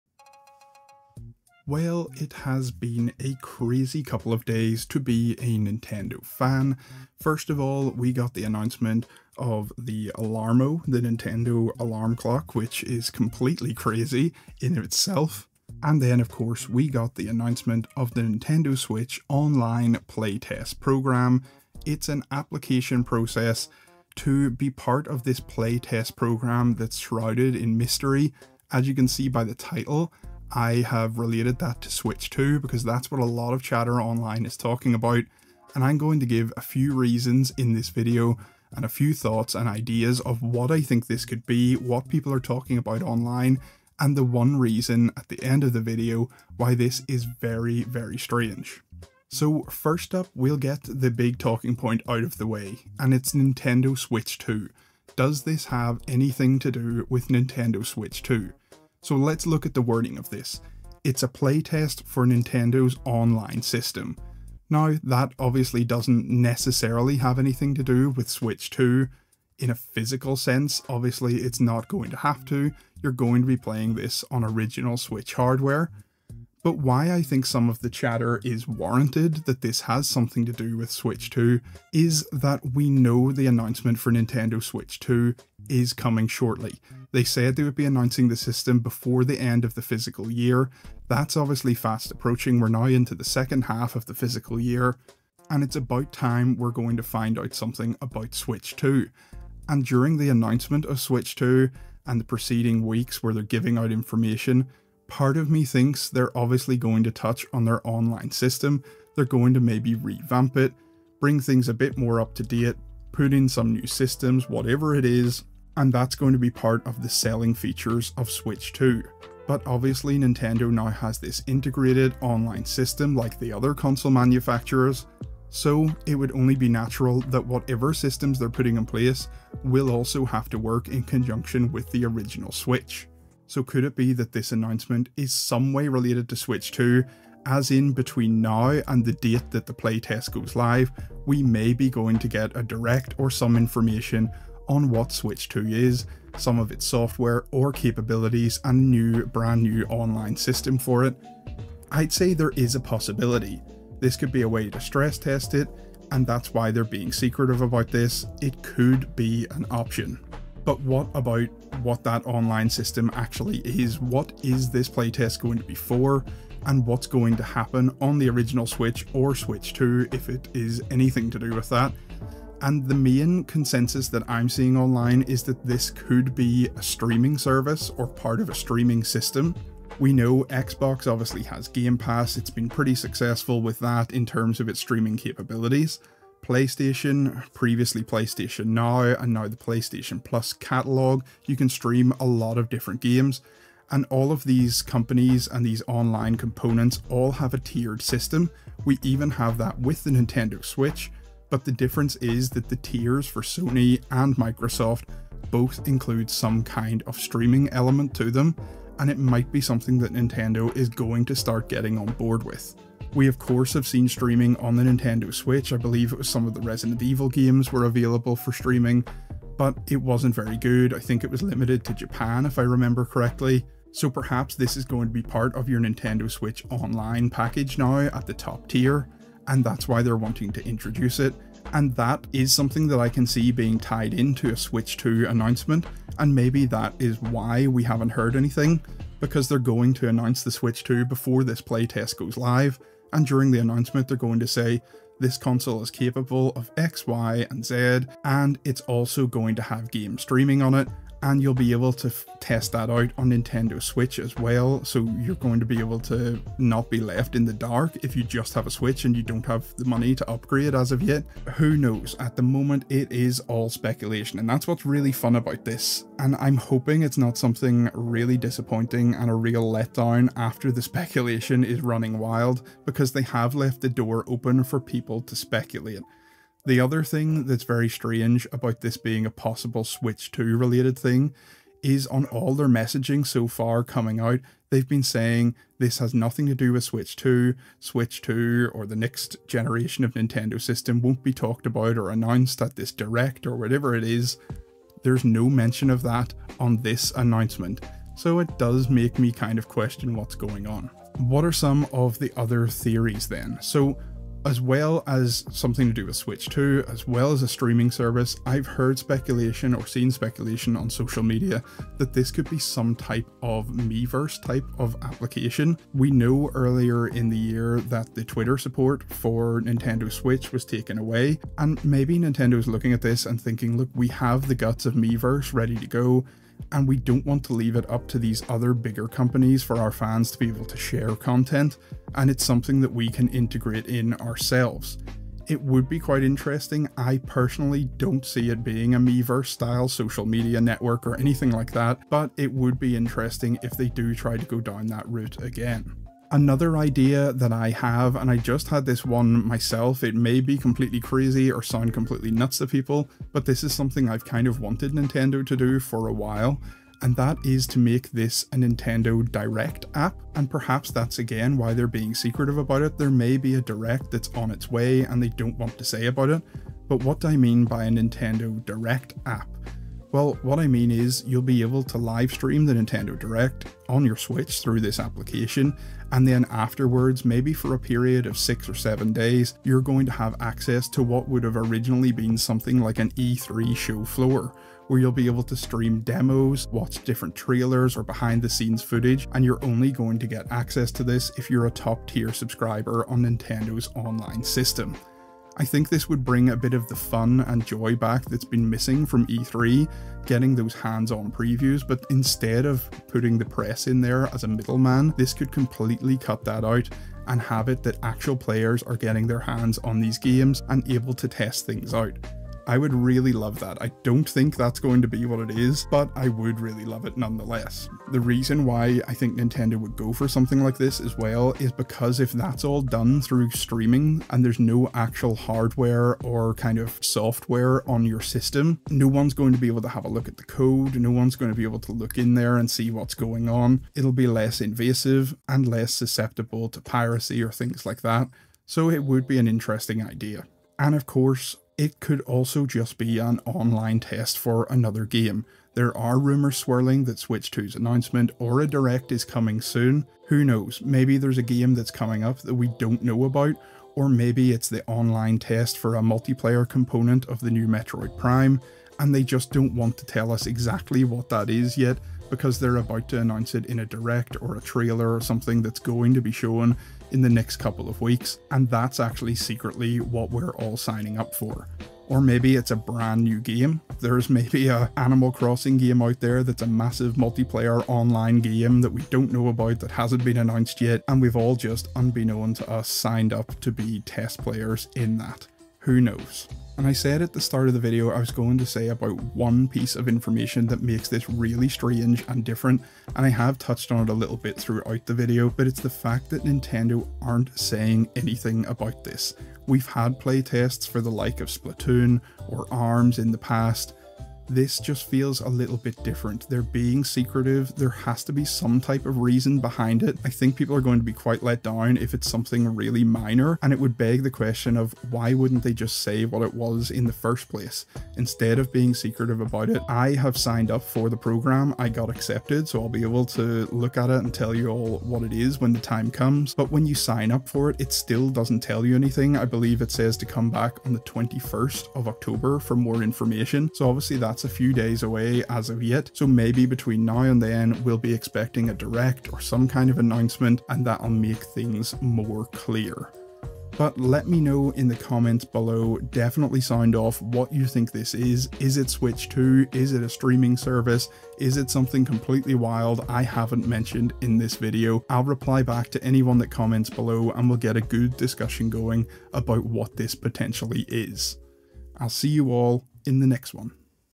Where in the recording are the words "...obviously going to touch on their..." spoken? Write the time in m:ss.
1:46.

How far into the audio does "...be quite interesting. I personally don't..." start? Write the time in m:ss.
5:35.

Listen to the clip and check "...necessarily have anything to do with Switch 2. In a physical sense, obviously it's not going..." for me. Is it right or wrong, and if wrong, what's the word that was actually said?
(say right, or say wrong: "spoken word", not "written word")
right.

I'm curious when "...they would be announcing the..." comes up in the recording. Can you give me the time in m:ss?
1:27.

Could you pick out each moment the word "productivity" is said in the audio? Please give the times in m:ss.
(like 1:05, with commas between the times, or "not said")
not said.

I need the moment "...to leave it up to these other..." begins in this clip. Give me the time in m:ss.
5:27.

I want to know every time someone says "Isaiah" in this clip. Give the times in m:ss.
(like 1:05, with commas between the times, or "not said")
not said.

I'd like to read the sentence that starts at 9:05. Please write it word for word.
Definitely sound off what you think this is.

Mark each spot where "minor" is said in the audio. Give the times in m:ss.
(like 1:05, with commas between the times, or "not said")
8:33.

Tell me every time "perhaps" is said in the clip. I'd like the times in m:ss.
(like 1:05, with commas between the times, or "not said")
3:44, 6:00.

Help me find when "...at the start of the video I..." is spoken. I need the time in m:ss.
8:07.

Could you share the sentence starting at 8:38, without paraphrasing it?
Instead of being secretive about it, I have signed up for the program.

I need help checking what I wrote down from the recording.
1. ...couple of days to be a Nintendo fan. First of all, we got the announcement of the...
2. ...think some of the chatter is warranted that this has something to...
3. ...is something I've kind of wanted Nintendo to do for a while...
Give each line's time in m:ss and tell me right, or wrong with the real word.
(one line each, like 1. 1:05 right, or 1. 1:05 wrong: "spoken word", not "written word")
1. 0:04 right
2. 1:17 right
3. 5:53 right.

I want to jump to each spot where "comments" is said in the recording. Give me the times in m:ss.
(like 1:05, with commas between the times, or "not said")
9:04, 9:16.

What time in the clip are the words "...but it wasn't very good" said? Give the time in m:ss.
3:39.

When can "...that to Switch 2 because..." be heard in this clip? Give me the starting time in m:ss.
0:31.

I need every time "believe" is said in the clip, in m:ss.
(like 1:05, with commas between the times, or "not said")
3:35, 8:49.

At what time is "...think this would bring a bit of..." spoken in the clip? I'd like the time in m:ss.
6:35.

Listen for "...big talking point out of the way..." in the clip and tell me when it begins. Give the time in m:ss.
0:51.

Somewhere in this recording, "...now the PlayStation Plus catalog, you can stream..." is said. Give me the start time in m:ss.
3:09.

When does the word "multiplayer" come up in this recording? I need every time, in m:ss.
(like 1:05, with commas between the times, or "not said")
7:36, 7:57.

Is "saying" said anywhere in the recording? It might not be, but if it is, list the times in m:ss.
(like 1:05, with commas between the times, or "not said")
4:45, 8:17.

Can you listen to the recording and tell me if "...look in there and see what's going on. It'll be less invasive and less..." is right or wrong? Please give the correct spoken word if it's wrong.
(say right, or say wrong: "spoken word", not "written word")
right.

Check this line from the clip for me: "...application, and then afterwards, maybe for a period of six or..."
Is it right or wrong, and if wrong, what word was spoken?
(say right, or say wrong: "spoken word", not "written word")
right.